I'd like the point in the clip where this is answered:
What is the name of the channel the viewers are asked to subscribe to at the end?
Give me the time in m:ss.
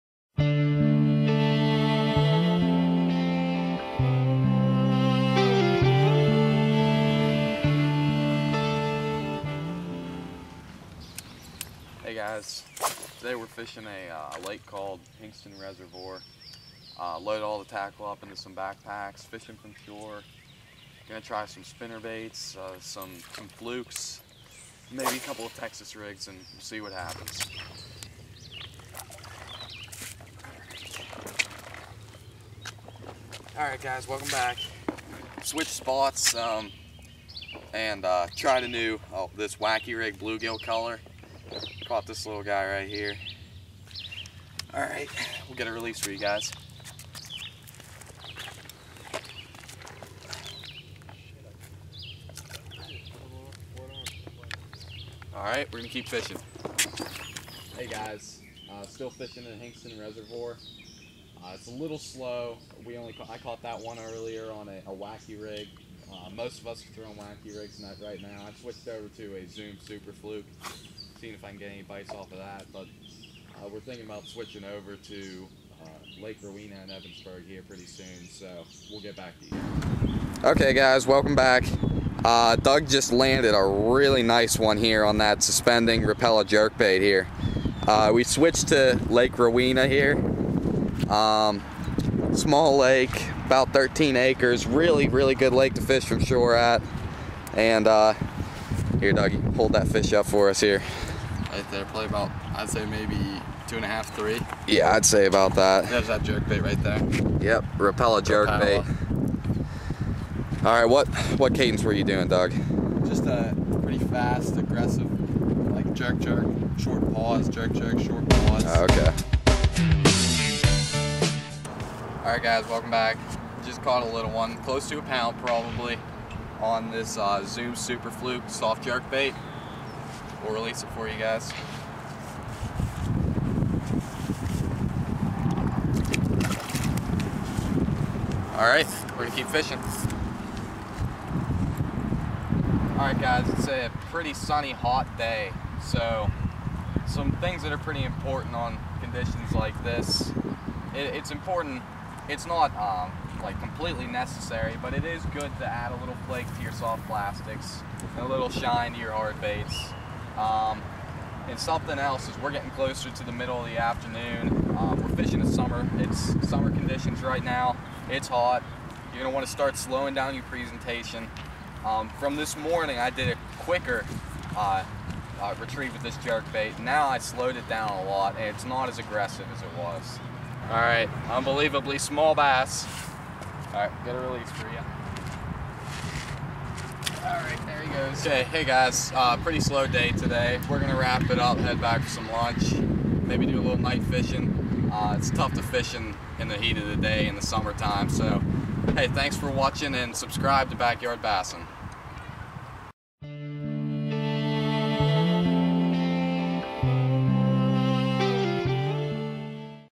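3:20.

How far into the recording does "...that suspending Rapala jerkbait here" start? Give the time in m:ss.
1:25.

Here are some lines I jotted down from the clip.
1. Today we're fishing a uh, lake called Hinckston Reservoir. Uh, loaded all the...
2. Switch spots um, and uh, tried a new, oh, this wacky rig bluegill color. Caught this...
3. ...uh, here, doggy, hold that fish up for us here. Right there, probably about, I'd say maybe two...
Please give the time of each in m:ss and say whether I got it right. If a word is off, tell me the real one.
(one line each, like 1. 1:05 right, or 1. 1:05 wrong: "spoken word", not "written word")
1. 0:13 right
2. 0:35 right
3. 1:37 right.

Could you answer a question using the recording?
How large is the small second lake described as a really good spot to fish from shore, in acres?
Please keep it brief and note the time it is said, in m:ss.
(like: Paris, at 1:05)
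13 acres, at 1:33.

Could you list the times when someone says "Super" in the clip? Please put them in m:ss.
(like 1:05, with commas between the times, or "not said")
1:09, 2:07.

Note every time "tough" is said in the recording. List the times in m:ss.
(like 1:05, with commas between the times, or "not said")
3:15.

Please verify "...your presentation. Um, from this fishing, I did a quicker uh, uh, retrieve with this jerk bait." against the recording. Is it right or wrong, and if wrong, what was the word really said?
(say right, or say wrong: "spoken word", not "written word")
wrong: "morning", not "fishing".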